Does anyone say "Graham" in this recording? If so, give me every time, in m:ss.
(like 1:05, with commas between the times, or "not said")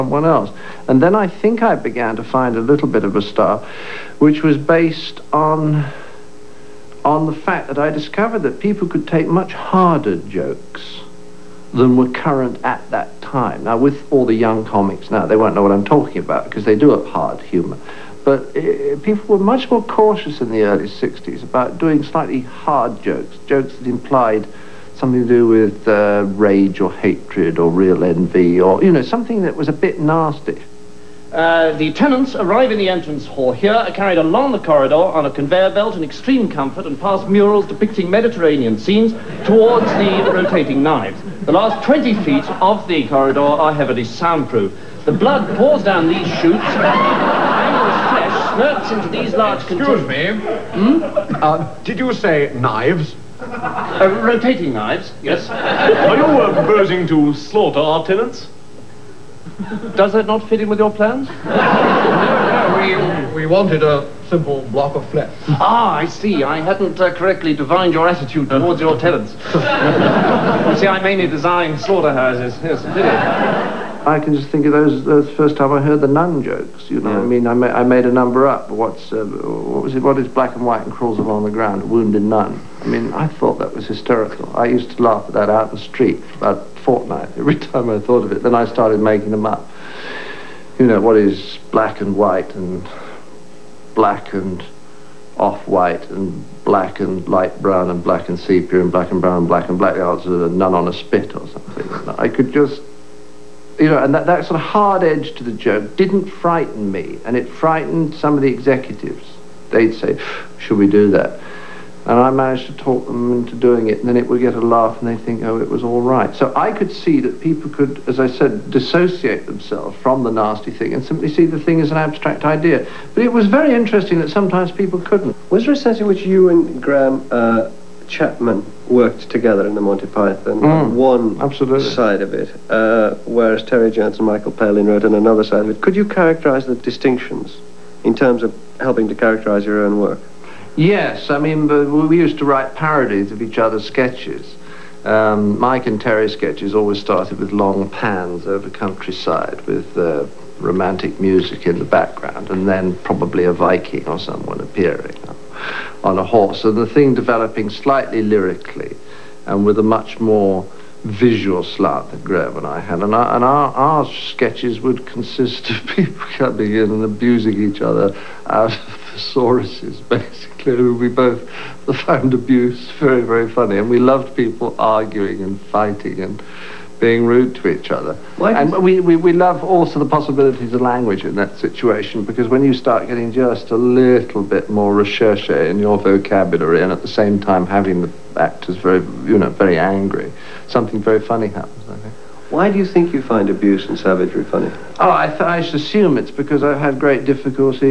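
2:06, 2:42.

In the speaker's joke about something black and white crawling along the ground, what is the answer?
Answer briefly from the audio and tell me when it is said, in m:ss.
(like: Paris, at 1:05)
A wounded nun, at 1:21.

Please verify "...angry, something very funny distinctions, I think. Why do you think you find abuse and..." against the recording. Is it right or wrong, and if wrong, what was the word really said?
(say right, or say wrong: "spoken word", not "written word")
wrong: "happens", not "distinctions".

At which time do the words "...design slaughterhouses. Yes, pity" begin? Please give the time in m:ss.
1:11.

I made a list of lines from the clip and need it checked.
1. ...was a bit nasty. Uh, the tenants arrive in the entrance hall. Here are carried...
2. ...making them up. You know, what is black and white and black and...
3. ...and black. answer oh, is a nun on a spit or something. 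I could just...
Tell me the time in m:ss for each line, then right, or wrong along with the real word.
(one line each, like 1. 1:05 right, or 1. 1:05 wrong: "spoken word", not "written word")
1. 0:29 right
2. 1:28 right
3. 1:39 right.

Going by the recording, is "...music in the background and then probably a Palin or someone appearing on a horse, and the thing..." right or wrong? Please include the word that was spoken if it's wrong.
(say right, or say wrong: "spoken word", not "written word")
wrong: "Viking", not "Palin".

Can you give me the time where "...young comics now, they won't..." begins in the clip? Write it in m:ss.
0:14.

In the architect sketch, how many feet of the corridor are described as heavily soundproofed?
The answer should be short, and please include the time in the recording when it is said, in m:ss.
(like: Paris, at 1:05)
20, at 0:41.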